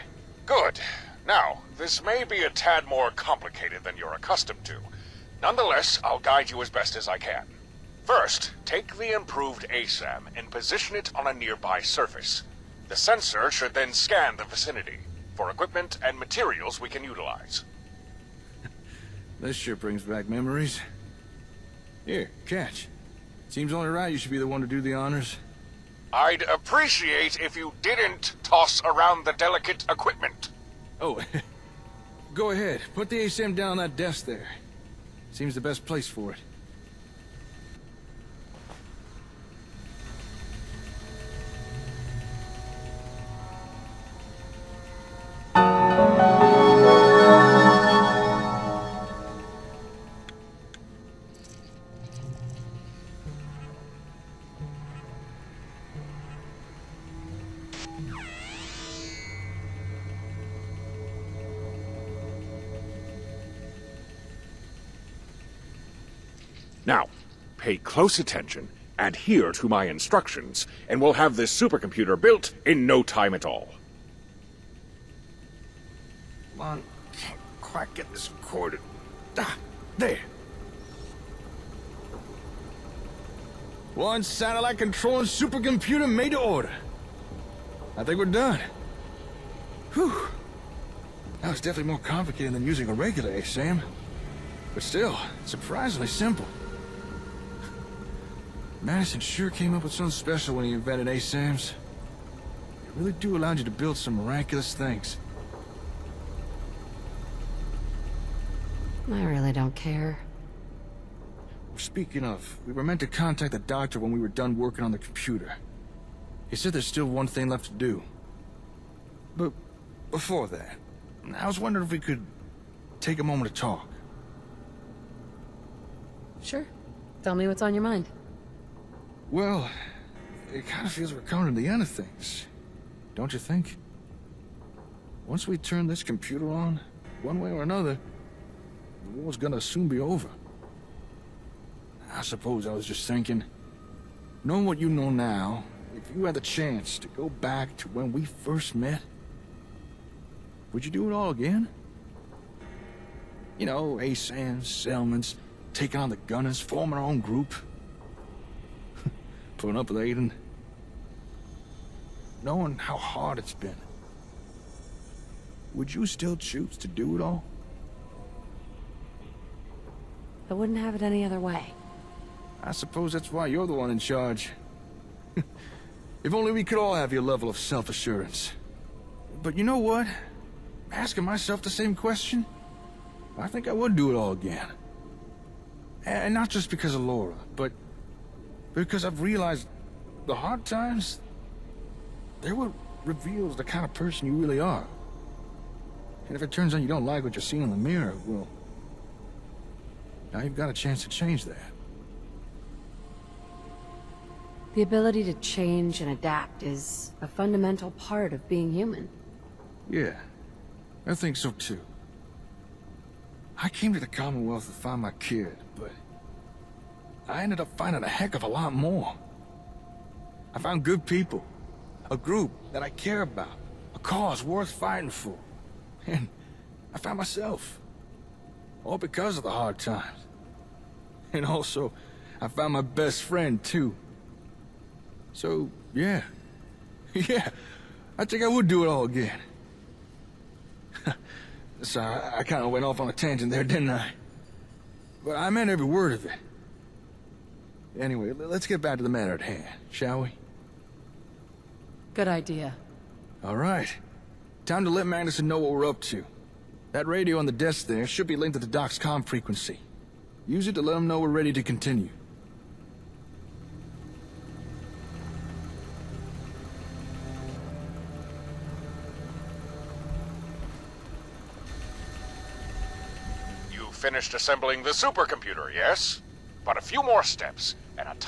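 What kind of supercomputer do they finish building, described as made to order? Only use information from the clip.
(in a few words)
satellite control supercomputer.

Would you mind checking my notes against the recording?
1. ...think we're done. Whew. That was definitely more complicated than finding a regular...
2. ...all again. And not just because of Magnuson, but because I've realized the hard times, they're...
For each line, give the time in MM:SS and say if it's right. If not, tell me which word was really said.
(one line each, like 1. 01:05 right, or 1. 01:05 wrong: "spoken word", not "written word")
1. 01:28 wrong: "using", not "finding"
2. 03:04 wrong: "Laura", not "Magnuson".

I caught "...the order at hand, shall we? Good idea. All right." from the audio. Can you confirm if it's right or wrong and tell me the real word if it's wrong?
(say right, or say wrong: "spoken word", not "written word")
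wrong: "matter", not "order".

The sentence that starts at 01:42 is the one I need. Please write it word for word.
They really do allow you to build some miraculous things.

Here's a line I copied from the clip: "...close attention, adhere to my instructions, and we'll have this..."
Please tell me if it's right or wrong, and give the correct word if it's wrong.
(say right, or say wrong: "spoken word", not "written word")
right.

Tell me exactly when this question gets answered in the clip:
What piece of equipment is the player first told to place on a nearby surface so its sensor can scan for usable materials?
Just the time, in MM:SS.
00:09.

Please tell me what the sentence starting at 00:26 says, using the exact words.
I'd appreciate if you didn't toss around the delicate equipment.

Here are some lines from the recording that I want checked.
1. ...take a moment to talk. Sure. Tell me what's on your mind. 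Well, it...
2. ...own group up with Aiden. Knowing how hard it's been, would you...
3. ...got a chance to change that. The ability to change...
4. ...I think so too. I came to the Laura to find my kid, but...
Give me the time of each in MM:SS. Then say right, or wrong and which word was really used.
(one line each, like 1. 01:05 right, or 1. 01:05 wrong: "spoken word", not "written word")
1. 02:03 right
2. 02:37 right
3. 03:20 right
4. 03:31 wrong: "Commonwealth", not "Laura".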